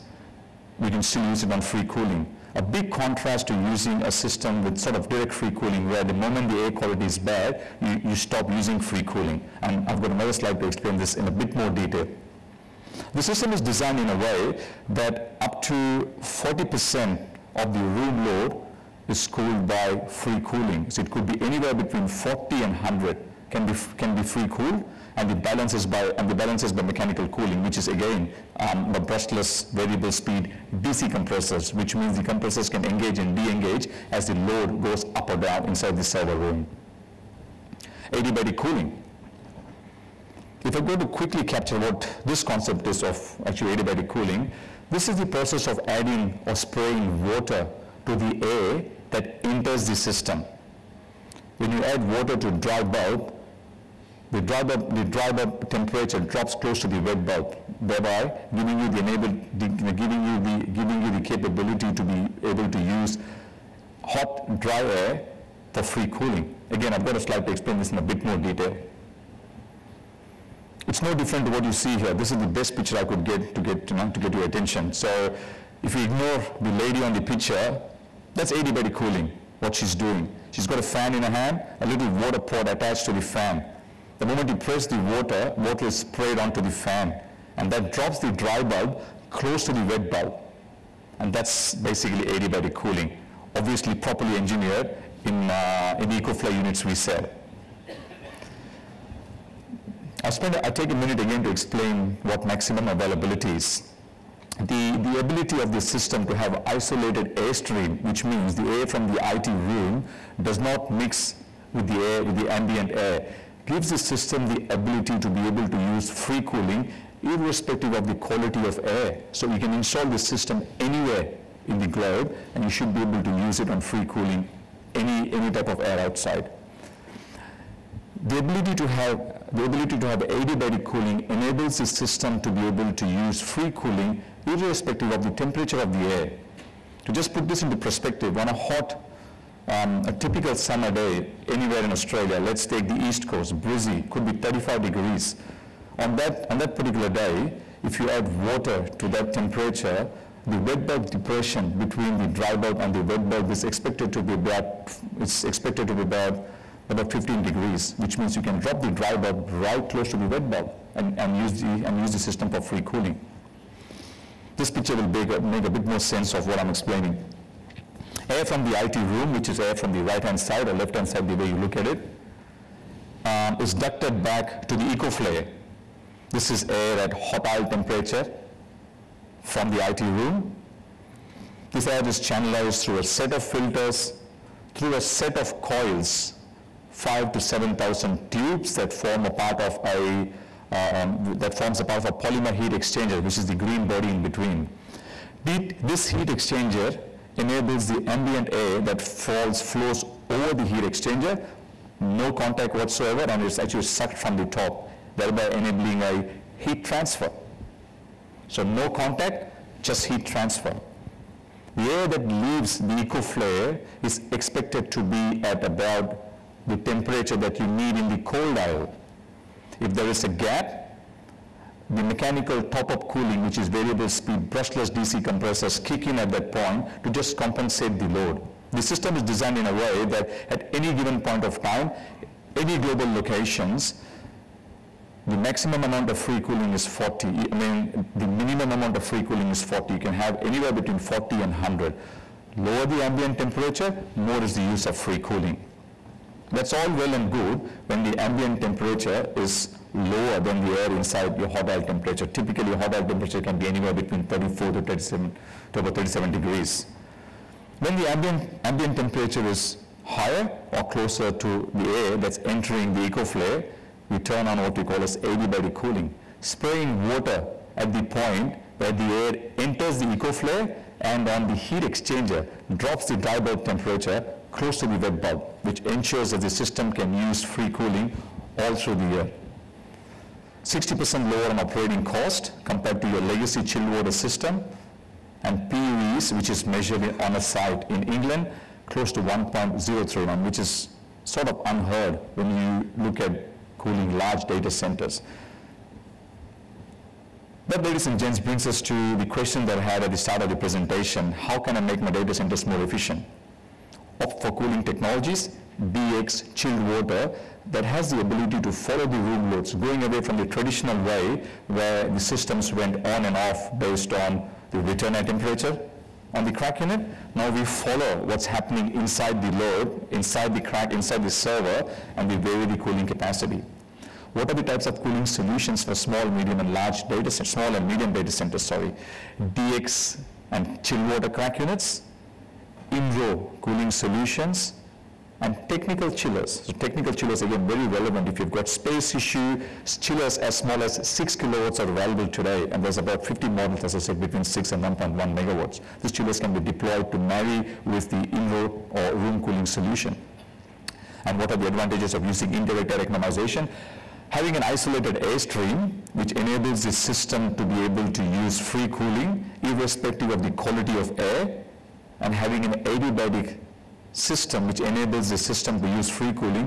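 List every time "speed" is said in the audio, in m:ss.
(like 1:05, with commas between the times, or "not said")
0:30, 3:44.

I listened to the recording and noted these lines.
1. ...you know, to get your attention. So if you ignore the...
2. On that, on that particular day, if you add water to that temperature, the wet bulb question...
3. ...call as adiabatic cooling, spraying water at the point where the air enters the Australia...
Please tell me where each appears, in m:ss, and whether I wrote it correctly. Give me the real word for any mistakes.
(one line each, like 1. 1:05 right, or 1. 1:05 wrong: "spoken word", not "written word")
1. 1:13 right
2. 2:25 wrong: "depression", not "question"
3. 4:24 wrong: "Ecoflair", not "Australia".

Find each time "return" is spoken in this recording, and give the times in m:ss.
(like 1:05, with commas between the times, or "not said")
5:14.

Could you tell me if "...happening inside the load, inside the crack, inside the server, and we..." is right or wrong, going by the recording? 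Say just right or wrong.
right.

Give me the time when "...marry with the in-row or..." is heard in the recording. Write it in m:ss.
5:47.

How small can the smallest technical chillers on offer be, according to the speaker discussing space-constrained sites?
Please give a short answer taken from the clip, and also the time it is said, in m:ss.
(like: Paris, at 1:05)
6 kilowatts, at 5:41.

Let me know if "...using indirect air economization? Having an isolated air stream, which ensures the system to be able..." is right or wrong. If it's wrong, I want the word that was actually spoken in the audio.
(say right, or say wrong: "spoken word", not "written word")
wrong: "enables", not "ensures".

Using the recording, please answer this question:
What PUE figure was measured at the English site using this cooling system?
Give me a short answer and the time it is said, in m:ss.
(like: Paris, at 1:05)
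1.039, at 4:49.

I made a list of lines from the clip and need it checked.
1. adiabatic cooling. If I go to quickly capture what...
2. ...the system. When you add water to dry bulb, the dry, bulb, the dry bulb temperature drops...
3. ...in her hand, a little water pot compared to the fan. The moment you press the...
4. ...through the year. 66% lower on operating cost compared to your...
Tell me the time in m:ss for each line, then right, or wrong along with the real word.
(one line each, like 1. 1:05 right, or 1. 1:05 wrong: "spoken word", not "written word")
1. 0:38 right
2. 0:49 right
3. 1:21 wrong: "attached", not "compared"
4. 4:38 wrong: "60", not "66".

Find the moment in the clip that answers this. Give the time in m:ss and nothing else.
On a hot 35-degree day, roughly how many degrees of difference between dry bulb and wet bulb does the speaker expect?
2:37.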